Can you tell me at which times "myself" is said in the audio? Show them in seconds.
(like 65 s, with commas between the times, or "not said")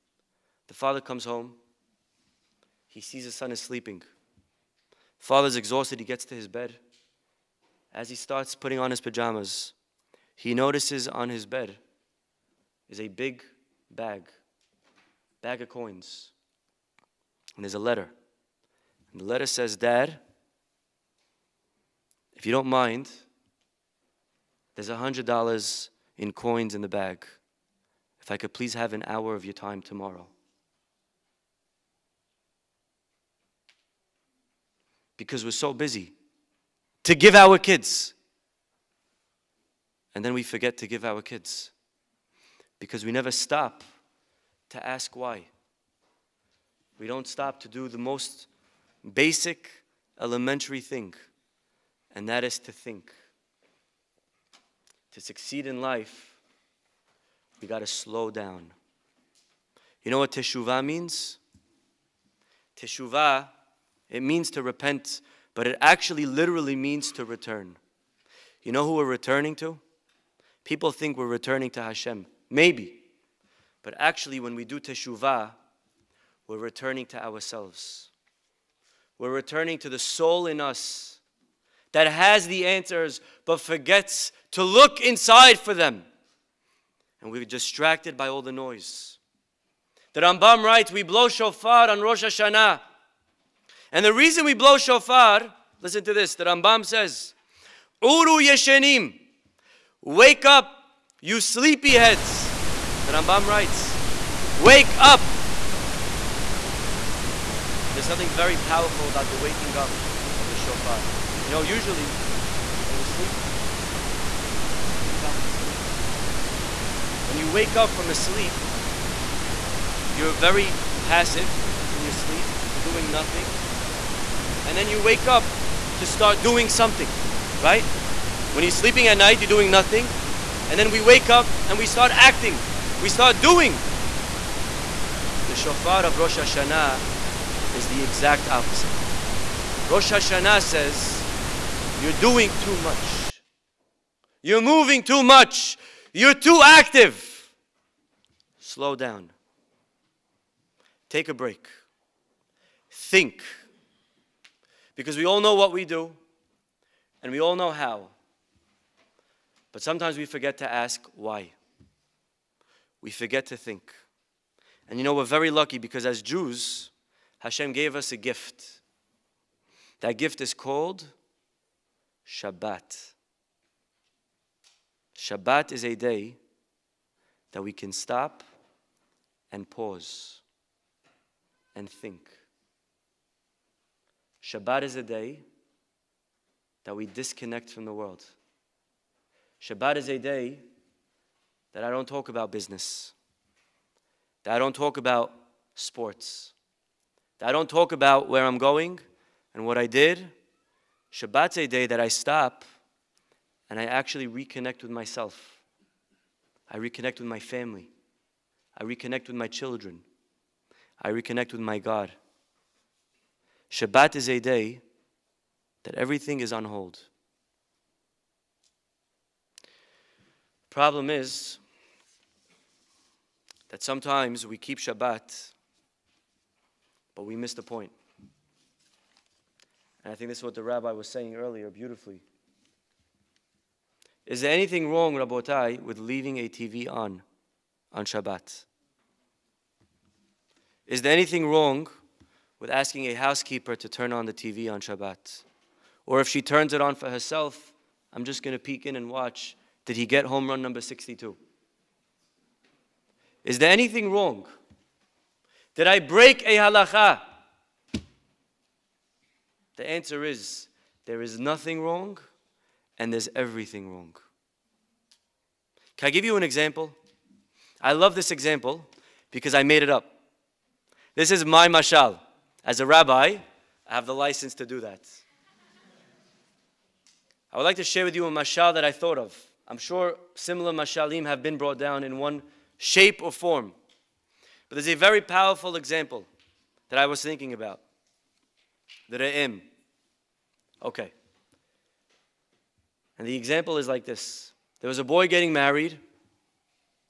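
204 s.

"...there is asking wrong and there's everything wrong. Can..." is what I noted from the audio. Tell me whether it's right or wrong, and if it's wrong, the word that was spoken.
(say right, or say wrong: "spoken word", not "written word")
wrong: "nothing", not "asking".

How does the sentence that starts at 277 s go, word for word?
I would like to share with you a mashal that I thought of.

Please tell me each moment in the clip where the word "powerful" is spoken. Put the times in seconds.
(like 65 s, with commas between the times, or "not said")
108 s, 285 s.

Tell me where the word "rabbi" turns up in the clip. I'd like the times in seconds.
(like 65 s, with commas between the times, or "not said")
230 s, 272 s.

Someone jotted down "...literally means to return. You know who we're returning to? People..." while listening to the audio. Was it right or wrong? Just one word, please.
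right.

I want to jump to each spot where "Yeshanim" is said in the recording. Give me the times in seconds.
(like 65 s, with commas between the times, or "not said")
98 s.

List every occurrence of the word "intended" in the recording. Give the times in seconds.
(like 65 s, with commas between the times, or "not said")
not said.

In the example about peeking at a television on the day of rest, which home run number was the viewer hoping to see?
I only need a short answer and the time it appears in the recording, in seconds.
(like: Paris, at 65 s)
62, at 250 s.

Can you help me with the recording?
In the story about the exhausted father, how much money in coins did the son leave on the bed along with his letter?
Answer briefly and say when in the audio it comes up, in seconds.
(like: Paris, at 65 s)
$100, at 24 s.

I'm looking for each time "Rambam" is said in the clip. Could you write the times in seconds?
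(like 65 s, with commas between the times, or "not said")
90 s, 96 s, 103 s.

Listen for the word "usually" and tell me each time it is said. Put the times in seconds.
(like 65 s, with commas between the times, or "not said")
111 s.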